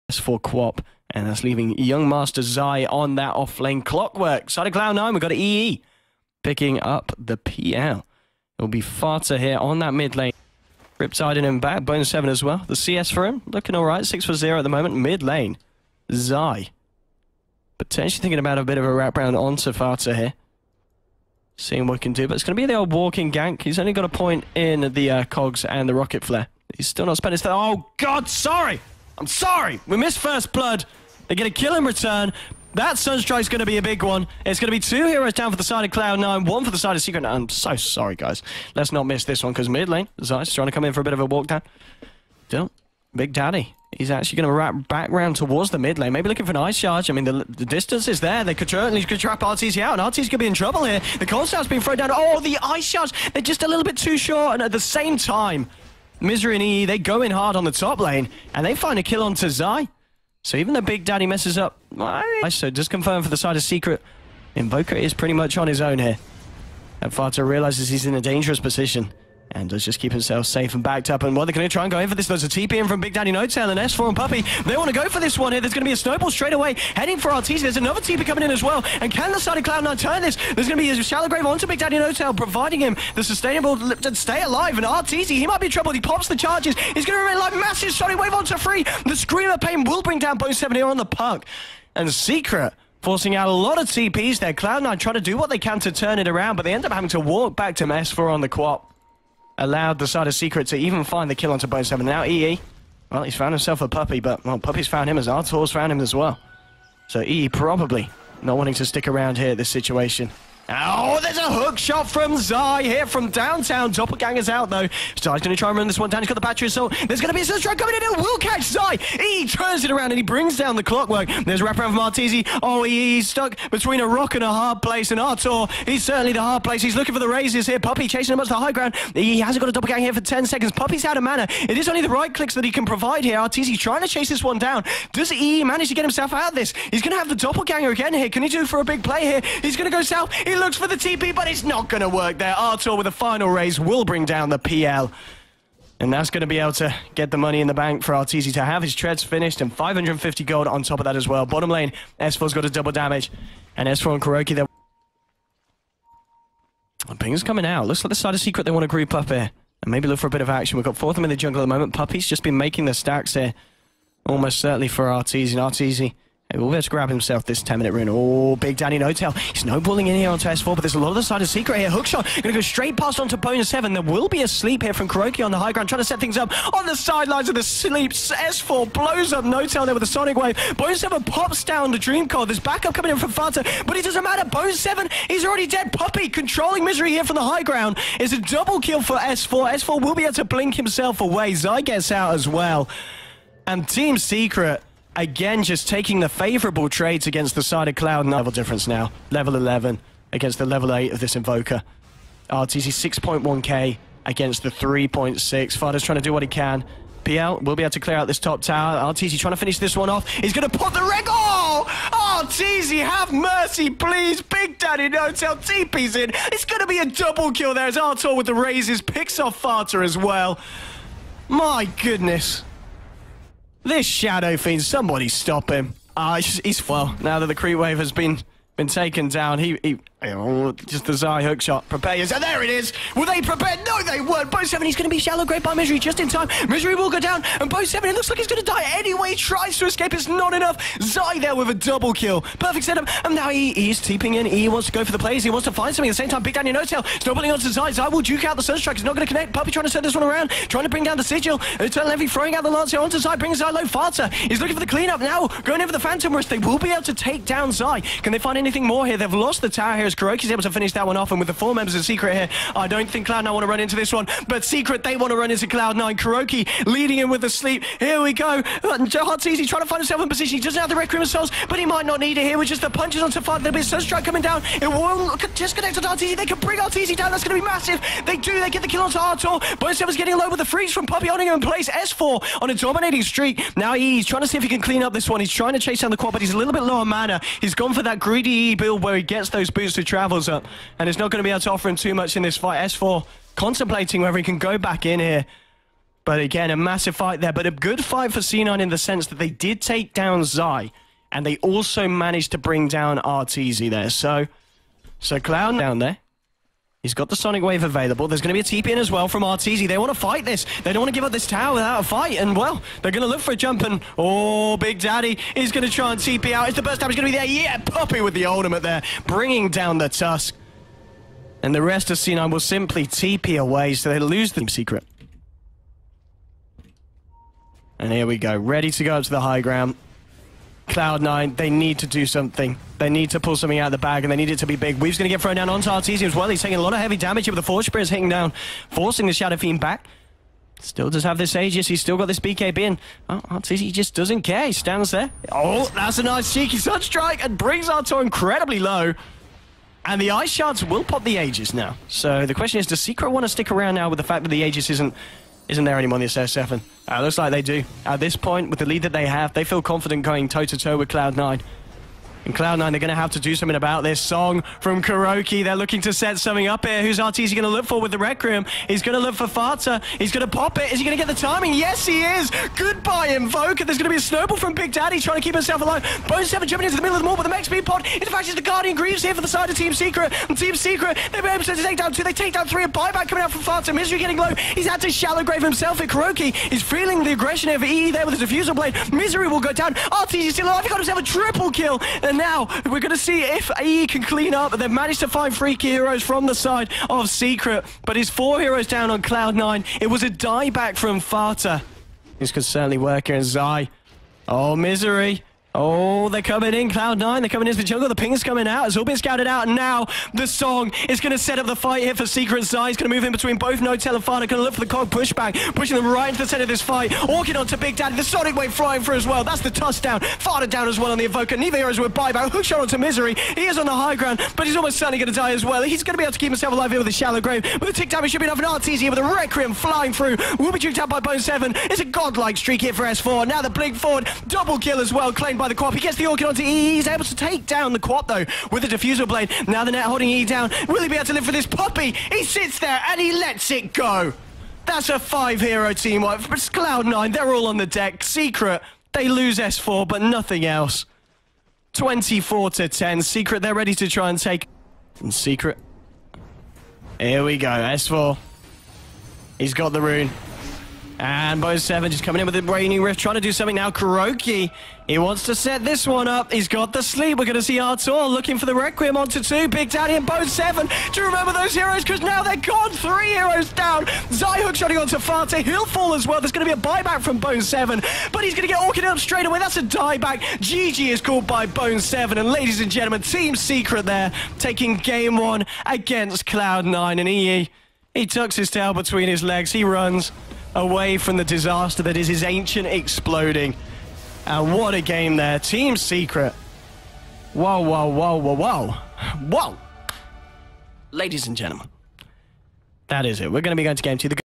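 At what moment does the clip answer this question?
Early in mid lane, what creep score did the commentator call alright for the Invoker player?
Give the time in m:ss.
0:14.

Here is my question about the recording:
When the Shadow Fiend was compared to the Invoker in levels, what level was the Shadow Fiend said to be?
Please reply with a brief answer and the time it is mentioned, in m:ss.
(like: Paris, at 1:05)
11, at 3:19.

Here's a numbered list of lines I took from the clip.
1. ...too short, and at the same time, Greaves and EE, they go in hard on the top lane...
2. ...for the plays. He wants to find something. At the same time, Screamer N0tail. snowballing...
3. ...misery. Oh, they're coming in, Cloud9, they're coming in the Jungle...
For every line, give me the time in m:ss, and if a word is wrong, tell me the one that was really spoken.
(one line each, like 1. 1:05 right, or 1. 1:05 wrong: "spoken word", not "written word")
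1. 0:53 wrong: "Misery", not "Greaves"
2. 4:05 wrong: "Big", not "Screamer"
3. 6:44 right.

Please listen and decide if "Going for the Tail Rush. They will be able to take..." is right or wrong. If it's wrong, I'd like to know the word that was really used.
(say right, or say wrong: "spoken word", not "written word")
wrong: "Phantom", not "Tail".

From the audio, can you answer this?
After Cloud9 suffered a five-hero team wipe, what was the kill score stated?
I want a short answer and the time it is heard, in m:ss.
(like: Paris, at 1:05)
24 to 10, at 7:31.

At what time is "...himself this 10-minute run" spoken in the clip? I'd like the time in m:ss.
2:47.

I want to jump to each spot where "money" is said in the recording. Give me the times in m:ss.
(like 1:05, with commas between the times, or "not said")
2:27, 5:56.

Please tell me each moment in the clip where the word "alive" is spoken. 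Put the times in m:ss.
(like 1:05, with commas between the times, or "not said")
1:24, 6:15, 6:30, 7:06.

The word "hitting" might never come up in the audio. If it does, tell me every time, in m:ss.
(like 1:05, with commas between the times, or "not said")
5:38.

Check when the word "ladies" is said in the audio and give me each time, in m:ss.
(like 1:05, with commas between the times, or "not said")
8:02, 8:21.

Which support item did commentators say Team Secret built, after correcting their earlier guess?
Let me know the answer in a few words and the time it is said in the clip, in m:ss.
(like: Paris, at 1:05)
Guardian Greaves, at 6:18.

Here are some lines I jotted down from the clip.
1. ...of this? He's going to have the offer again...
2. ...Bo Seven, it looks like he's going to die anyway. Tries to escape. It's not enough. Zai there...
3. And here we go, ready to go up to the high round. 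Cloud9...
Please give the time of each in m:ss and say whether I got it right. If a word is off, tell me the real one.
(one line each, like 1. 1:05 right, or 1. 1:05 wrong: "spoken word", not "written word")
1. 2:16 wrong: "doppelganger", not "offer"
2. 3:57 right
3. 5:27 wrong: "ground", not "round".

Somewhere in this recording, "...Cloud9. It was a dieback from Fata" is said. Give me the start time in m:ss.
6:39.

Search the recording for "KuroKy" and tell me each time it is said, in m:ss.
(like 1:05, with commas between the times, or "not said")
2:34, 2:55, 4:20, 4:26, 6:05, 6:26, 7:43.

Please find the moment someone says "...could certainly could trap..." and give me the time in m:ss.
0:48.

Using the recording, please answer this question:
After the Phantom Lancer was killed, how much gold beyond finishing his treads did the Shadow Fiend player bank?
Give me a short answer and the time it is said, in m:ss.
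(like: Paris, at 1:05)
550, at 2:29.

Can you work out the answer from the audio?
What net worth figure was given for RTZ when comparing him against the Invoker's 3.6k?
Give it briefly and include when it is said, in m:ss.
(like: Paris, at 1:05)
6.1k, at 3:23.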